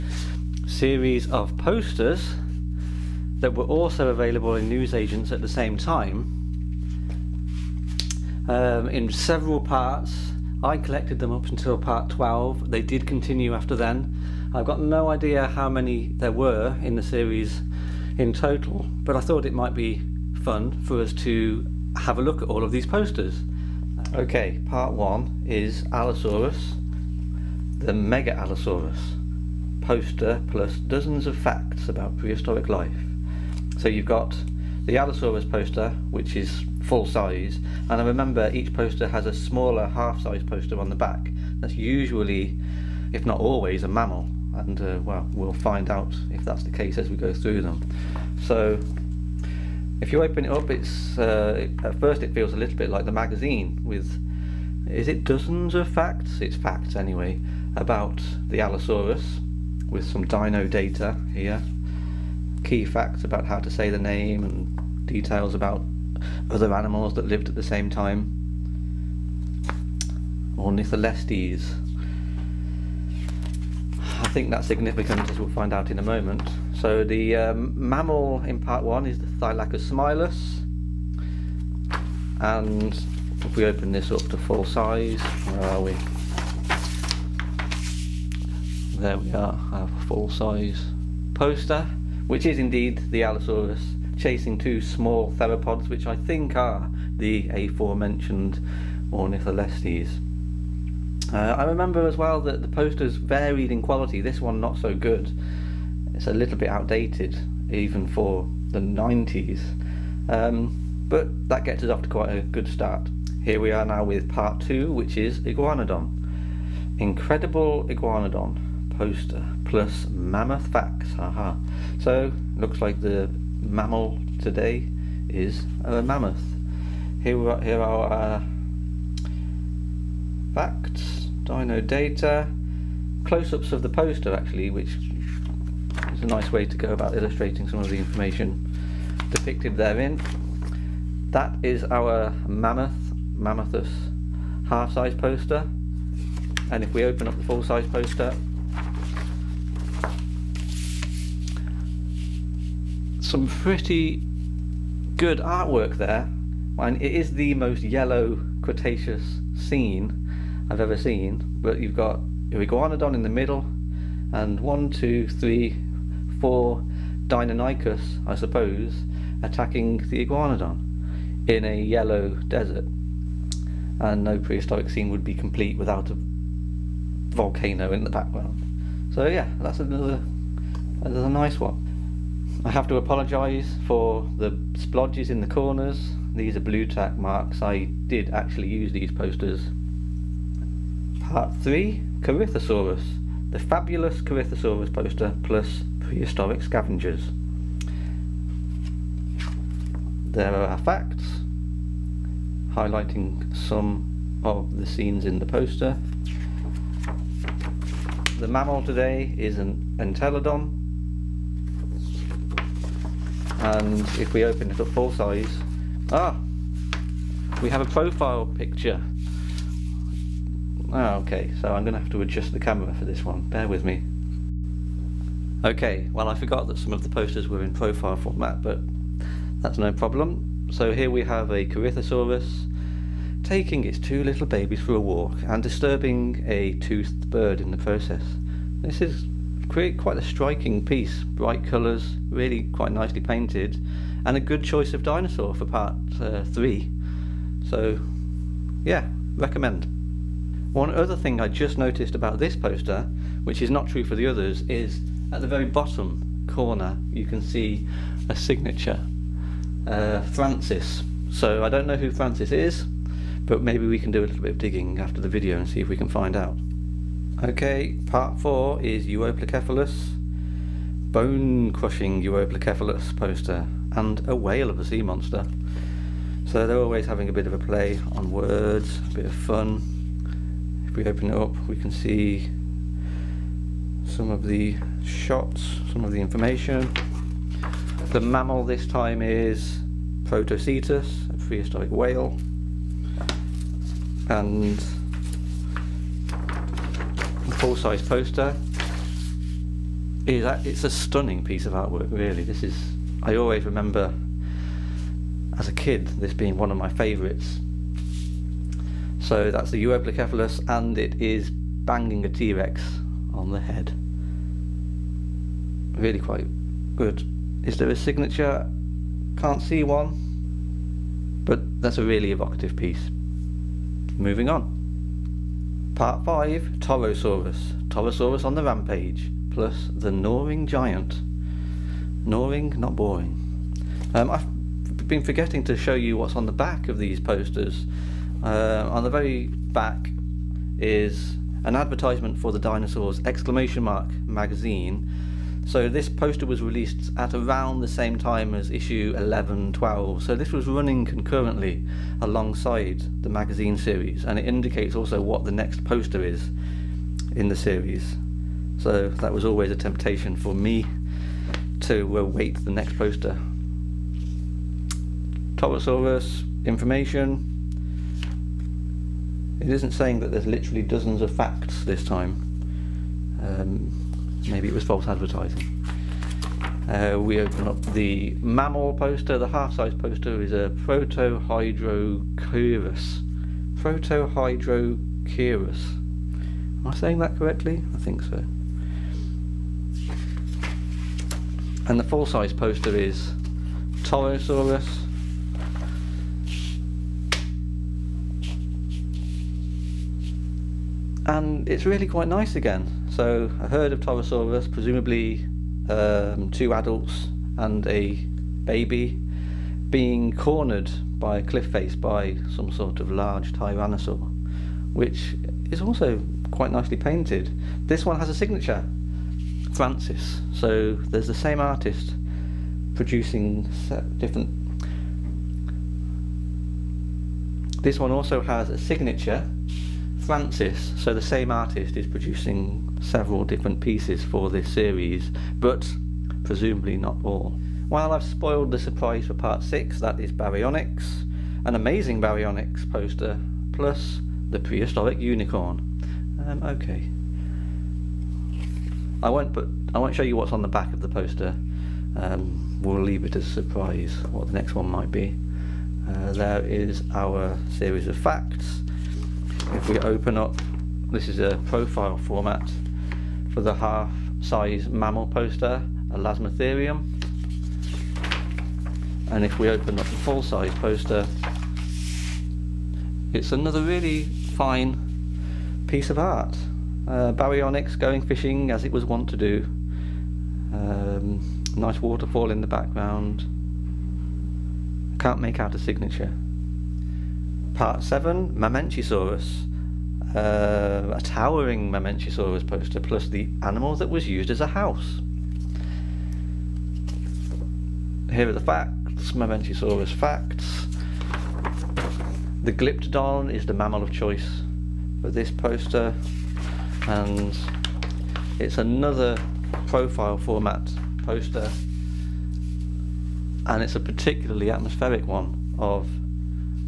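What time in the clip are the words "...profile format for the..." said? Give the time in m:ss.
7:41.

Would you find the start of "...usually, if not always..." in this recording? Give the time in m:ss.
0:41.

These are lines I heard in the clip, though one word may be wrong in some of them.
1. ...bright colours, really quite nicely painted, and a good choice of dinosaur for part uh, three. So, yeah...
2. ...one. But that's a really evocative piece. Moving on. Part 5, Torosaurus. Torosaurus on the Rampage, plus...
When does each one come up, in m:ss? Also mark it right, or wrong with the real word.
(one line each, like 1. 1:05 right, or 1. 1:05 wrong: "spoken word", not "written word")
1. 4:01 right
2. 5:19 right.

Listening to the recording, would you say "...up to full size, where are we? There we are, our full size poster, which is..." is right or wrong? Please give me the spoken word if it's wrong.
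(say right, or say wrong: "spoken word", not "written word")
right.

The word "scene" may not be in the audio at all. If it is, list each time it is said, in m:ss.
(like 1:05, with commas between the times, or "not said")
2:39, 2:54, 3:24.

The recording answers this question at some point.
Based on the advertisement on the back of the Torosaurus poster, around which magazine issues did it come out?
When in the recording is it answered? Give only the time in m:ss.
5:48.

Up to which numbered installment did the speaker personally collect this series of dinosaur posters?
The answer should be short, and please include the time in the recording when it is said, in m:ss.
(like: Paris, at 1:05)
Part 12, at 0:11.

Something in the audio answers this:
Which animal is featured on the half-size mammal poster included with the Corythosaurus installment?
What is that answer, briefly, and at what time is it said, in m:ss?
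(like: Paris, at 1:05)
Entelodon, at 3:29.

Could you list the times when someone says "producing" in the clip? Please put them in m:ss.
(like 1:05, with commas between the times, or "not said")
7:02, 7:12.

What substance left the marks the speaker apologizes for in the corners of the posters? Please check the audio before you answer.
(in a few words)
Blue tack.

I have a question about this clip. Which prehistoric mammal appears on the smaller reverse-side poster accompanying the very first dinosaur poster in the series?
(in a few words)
Thylacosmilus.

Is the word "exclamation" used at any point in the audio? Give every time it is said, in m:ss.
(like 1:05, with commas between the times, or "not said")
5:43.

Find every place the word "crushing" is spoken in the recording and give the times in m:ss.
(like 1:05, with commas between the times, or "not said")
4:31.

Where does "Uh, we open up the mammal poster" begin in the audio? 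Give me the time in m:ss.
6:16.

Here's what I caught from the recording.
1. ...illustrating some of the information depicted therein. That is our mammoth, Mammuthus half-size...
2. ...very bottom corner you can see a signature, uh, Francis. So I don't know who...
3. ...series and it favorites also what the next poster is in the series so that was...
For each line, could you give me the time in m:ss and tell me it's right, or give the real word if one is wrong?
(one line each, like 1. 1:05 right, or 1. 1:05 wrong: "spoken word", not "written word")
1. 2:17 right
2. 4:15 right
3. 5:53 wrong: "indicates", not "favorites".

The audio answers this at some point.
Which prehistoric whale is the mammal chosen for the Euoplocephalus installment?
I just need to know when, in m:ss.
4:50.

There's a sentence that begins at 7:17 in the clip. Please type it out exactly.
While I've spoiled the surprise for part 6, that is Baryonyx, an amazing Baryonyx poster, plus the prehistoric unicorn.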